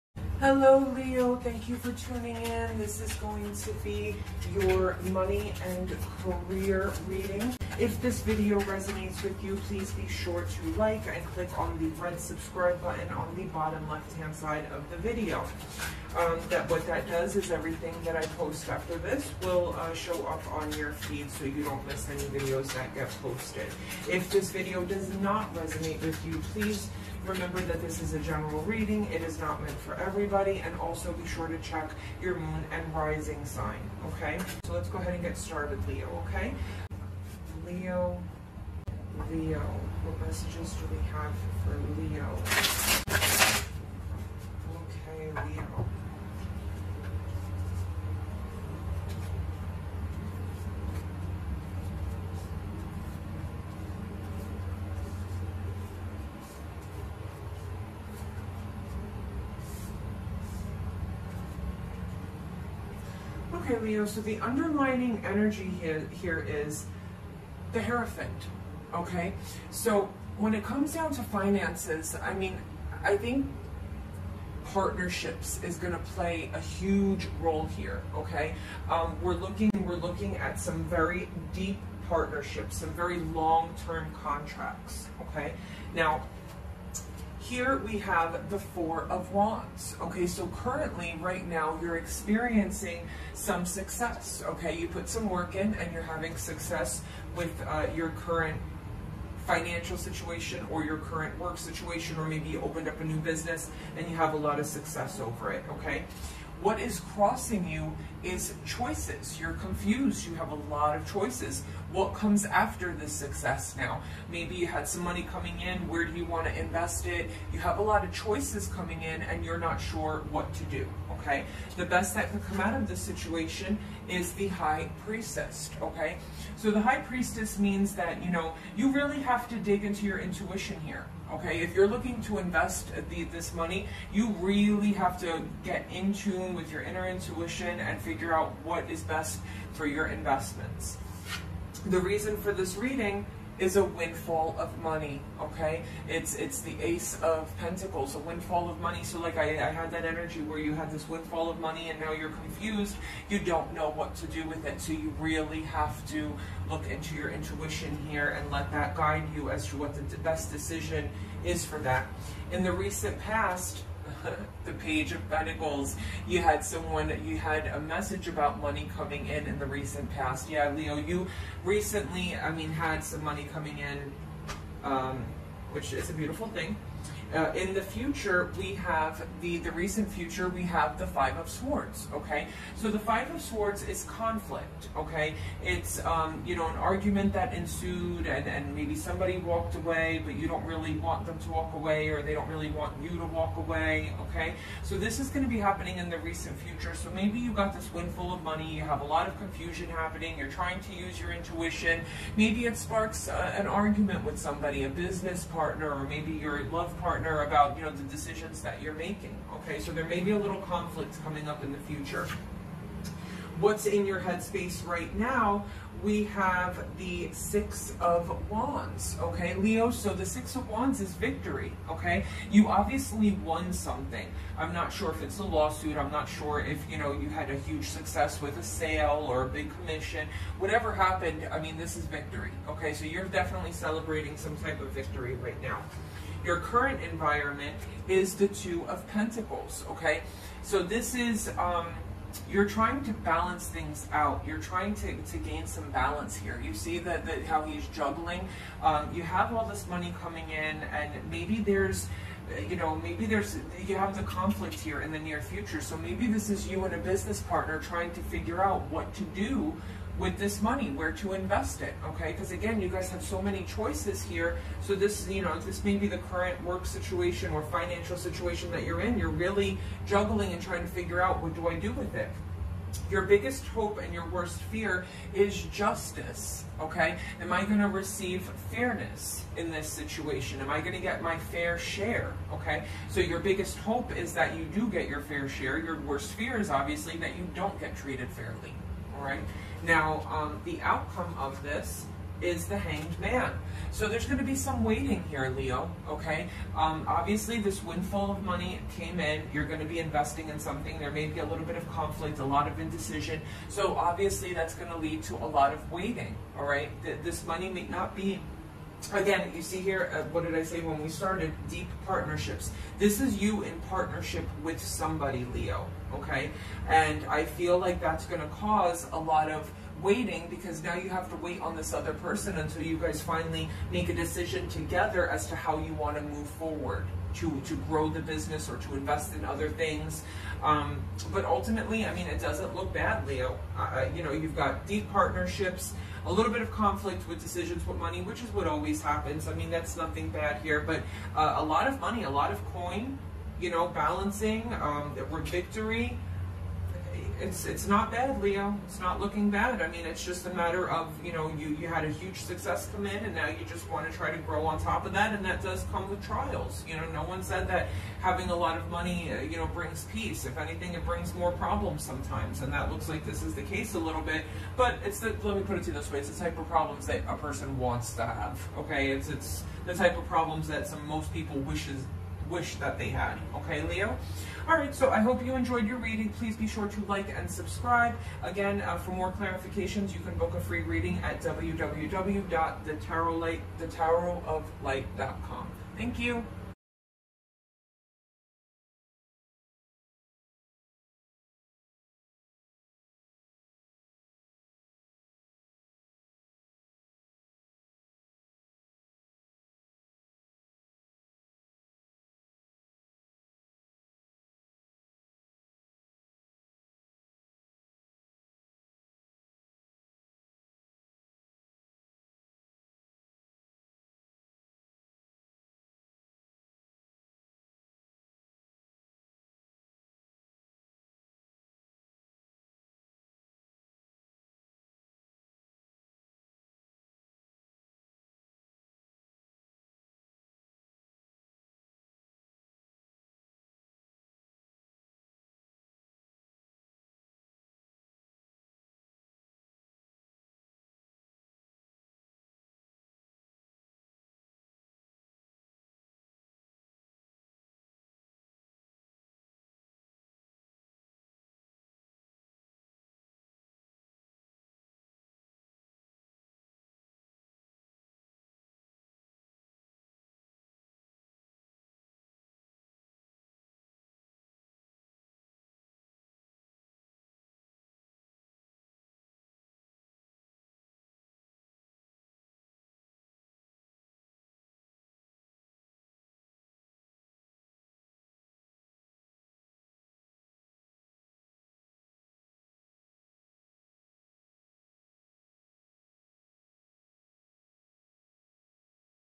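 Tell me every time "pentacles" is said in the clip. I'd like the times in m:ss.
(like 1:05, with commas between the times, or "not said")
2:27, 2:45, 3:59.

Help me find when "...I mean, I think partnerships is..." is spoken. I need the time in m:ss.
1:12.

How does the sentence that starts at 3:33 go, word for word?
What's in your headspace right now?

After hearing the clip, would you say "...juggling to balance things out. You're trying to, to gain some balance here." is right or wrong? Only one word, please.
wrong.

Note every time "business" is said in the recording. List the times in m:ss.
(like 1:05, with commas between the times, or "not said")
1:43, 3:24, 4:16, 5:28.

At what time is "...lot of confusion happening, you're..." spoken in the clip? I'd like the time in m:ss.
3:19.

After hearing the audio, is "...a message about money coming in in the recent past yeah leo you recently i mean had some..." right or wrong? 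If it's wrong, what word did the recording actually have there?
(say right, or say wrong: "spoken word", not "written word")
right.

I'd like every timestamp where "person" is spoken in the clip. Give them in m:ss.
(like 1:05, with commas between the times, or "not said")
5:22, 6:07.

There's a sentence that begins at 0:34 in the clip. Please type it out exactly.
So let's go ahead and get started, Leo, okay?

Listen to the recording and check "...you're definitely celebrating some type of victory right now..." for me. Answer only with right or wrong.
right.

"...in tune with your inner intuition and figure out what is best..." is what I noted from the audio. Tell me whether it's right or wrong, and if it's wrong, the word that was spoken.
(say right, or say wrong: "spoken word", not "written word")
right.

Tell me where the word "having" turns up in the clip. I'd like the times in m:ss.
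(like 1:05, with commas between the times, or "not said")
1:36, 5:58.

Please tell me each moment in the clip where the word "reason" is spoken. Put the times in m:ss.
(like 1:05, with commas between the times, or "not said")
2:22.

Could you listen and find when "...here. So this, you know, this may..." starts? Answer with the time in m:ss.
4:24.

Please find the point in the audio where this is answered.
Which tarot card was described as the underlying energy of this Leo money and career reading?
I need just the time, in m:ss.
1:07.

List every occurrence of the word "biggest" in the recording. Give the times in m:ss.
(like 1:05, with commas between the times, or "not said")
4:33, 4:43.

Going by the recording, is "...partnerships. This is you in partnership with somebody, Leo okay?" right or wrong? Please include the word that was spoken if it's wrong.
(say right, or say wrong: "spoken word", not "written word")
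right.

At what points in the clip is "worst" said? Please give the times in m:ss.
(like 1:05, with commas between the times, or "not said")
4:34, 4:46.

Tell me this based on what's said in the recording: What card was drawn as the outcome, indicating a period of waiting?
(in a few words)
The Hanged Man.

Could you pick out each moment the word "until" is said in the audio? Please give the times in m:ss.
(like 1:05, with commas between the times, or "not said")
5:22.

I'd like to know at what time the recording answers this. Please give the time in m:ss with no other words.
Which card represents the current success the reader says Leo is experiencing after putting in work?
1:28.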